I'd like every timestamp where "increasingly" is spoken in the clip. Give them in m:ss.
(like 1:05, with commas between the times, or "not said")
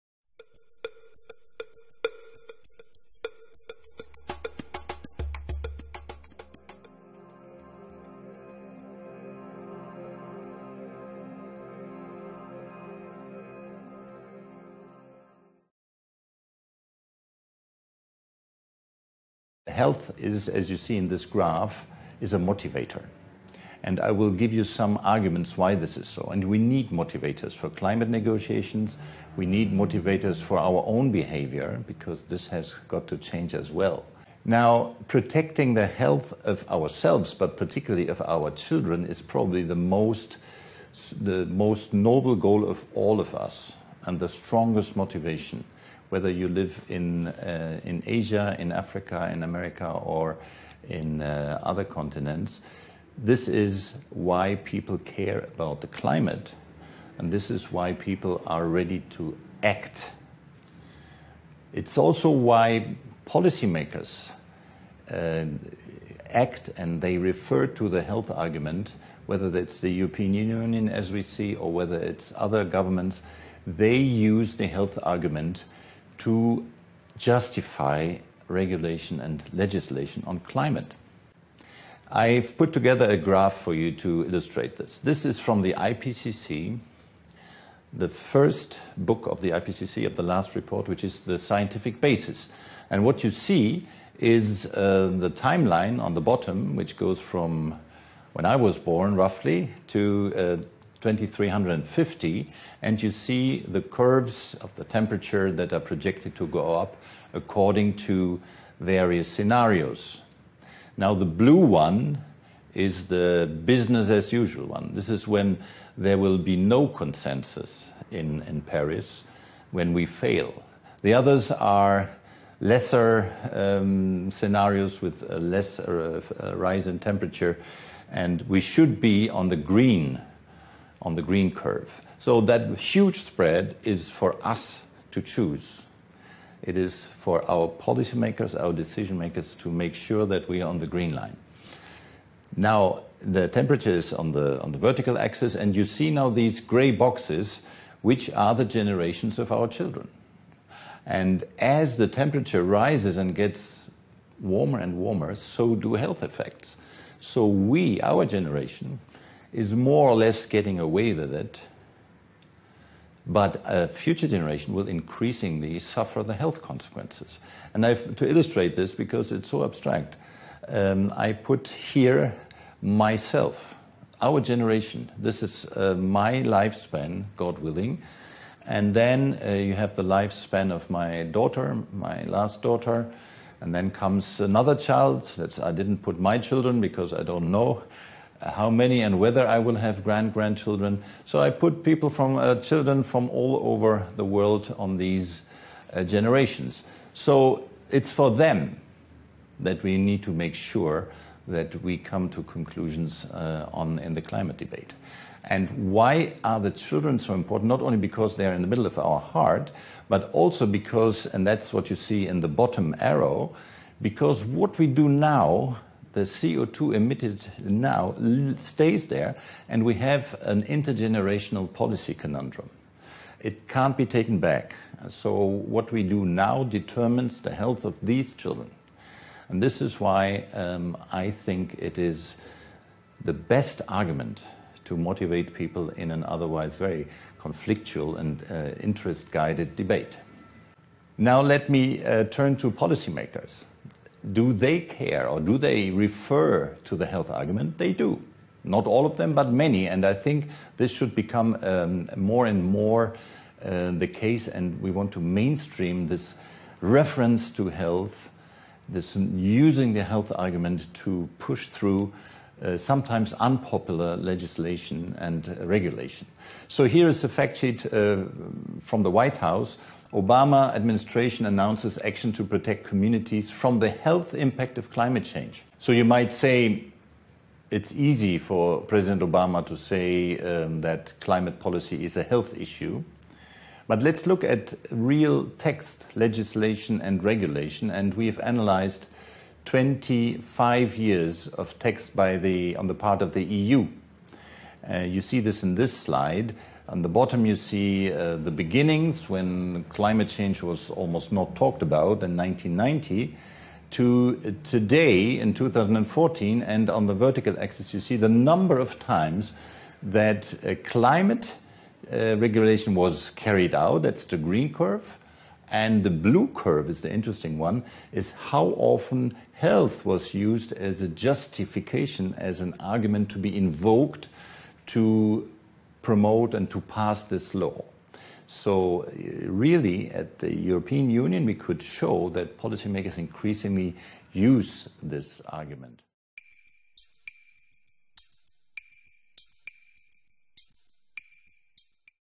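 2:44, 5:33.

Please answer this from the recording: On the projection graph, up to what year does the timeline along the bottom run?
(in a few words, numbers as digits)
2350.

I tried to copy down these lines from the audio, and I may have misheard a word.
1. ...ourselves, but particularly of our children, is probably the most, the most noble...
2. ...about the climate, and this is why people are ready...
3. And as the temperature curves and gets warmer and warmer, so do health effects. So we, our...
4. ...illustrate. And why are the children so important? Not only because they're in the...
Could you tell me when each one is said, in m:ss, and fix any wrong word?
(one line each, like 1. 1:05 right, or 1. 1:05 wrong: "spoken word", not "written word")
1. 0:36 right
2. 0:55 right
3. 2:31 wrong: "rises", not "curves"
4. 3:24 wrong: "debate", not "illustrate".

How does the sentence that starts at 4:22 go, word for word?
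Uh, sometimes unpopular legislation and regulation.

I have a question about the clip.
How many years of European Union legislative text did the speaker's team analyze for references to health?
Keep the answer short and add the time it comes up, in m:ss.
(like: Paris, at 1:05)
25, at 4:49.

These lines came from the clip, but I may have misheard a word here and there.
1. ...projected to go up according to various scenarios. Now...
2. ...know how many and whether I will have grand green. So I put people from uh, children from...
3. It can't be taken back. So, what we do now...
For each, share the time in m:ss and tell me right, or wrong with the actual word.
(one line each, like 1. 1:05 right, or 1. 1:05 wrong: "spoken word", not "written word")
1. 1:45 right
2. 3:07 wrong: "grandchildren", not "green"
3. 3:43 right.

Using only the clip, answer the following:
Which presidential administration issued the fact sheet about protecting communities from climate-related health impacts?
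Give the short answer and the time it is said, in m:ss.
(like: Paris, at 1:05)
Obama administration, at 4:30.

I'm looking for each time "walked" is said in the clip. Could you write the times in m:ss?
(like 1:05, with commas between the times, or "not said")
not said.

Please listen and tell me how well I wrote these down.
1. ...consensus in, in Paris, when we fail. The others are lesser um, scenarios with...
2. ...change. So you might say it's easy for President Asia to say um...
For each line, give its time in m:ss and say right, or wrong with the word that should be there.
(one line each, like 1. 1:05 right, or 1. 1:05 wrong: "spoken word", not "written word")
1. 1:56 right
2. 4:35 wrong: "Obama", not "Asia".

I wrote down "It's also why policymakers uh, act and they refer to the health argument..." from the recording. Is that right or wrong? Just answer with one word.
right.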